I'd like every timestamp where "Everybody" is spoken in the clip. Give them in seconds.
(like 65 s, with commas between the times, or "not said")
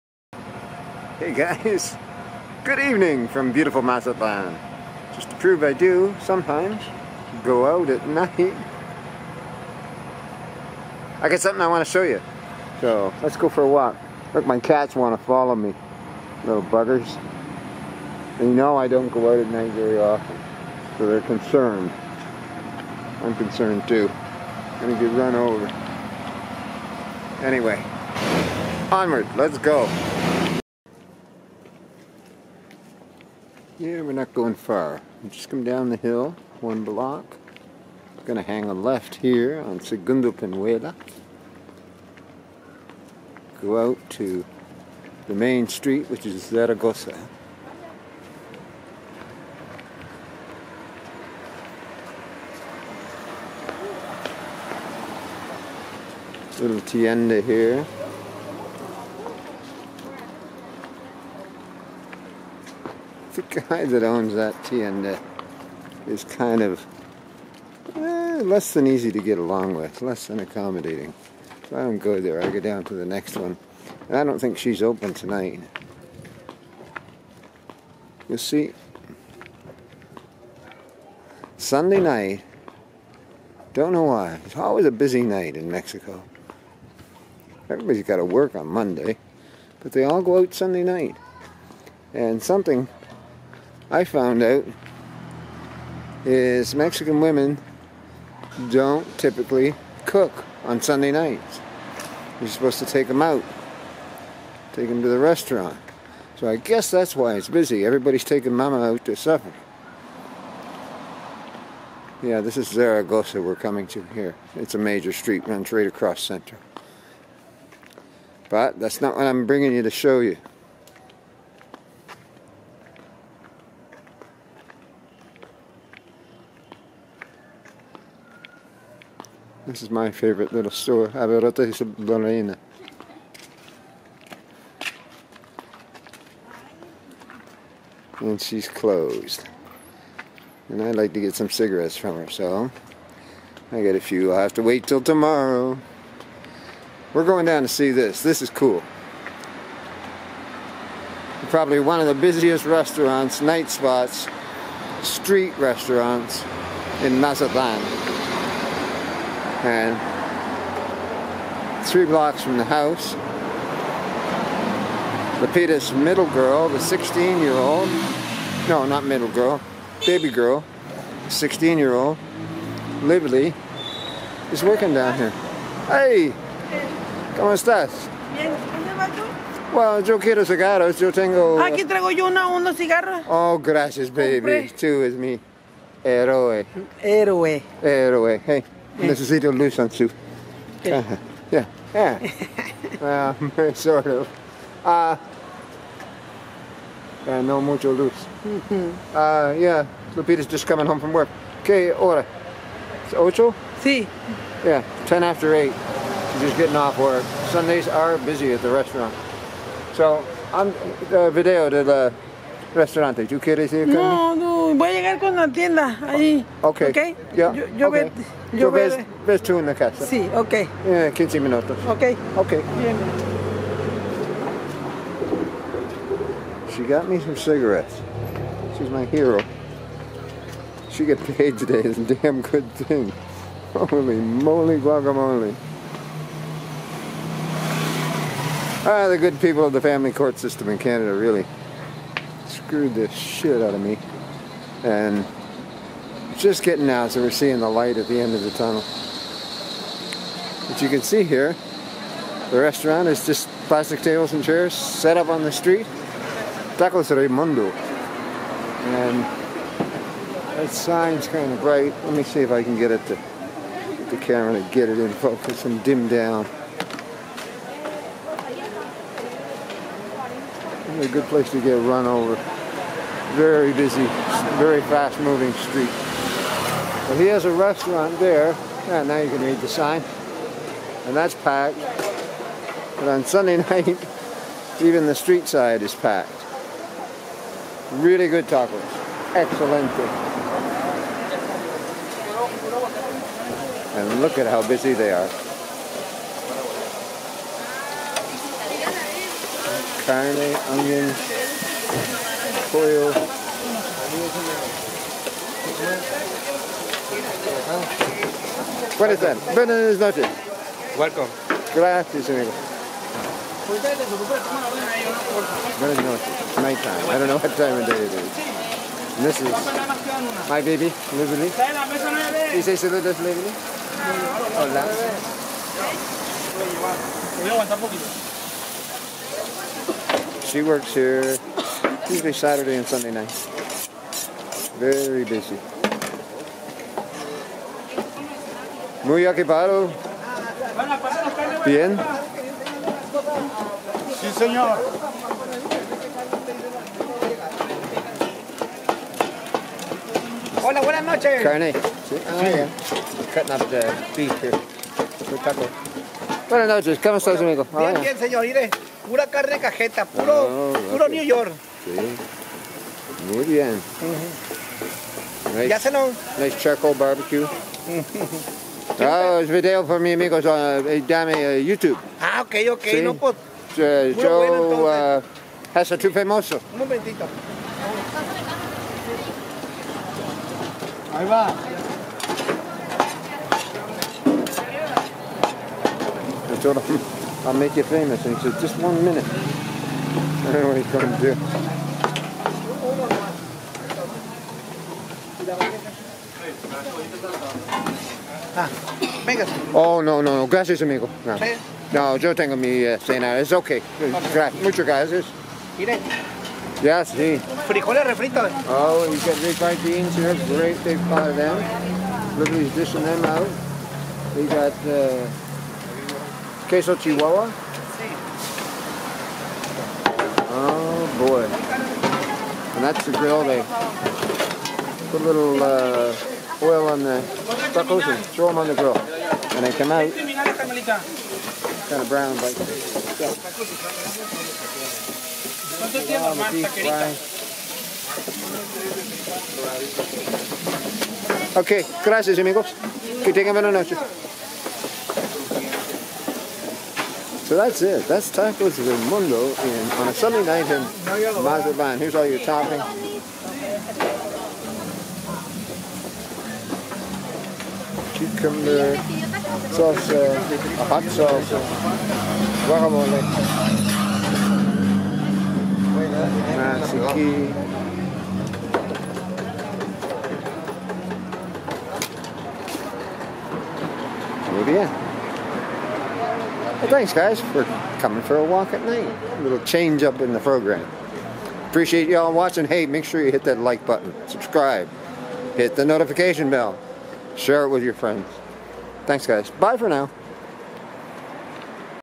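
87 s, 107 s.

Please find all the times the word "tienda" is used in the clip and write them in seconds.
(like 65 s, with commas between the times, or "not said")
56 s, 215 s.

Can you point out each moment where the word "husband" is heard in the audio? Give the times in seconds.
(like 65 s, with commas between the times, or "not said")
not said.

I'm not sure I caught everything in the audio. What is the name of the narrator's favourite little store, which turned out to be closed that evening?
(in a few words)
Averitas Lorena.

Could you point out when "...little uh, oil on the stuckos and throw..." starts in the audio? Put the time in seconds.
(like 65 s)
425 s.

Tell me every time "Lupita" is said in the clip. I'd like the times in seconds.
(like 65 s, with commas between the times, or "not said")
165 s, 200 s.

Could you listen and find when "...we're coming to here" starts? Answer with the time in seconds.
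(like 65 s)
113 s.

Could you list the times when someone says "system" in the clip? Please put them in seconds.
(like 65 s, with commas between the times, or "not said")
240 s.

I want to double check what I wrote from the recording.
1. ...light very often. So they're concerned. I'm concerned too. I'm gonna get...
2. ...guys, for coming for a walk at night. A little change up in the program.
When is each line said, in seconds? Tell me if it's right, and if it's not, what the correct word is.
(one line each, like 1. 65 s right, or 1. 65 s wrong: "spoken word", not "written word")
1. 19 s wrong: "night", not "light"
2. 477 s right.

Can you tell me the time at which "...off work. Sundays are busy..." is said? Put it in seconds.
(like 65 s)
206 s.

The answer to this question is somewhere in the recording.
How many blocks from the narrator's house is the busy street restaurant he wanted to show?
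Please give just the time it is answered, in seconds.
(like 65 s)
161 s.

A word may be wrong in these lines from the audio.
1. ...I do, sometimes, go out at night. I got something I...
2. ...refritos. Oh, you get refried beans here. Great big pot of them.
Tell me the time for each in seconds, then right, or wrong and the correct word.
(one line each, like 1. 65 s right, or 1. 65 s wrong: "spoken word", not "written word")
1. 5 s right
2. 408 s right.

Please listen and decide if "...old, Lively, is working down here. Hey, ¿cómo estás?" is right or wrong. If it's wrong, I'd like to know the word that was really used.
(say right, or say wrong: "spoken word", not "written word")
right.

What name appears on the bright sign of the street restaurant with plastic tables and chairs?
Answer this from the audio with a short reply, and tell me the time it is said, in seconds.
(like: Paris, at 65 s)
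Tacos Raymundo, at 256 s.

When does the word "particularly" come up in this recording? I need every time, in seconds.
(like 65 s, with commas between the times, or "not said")
not said.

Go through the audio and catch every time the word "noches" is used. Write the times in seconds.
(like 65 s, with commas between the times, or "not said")
309 s, 315 s, 351 s, 356 s, 443 s.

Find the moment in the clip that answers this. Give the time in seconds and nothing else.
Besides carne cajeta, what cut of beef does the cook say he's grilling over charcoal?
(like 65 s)
361 s.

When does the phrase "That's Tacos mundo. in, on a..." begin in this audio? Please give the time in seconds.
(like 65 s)
448 s.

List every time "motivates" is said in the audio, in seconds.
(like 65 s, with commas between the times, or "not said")
not said.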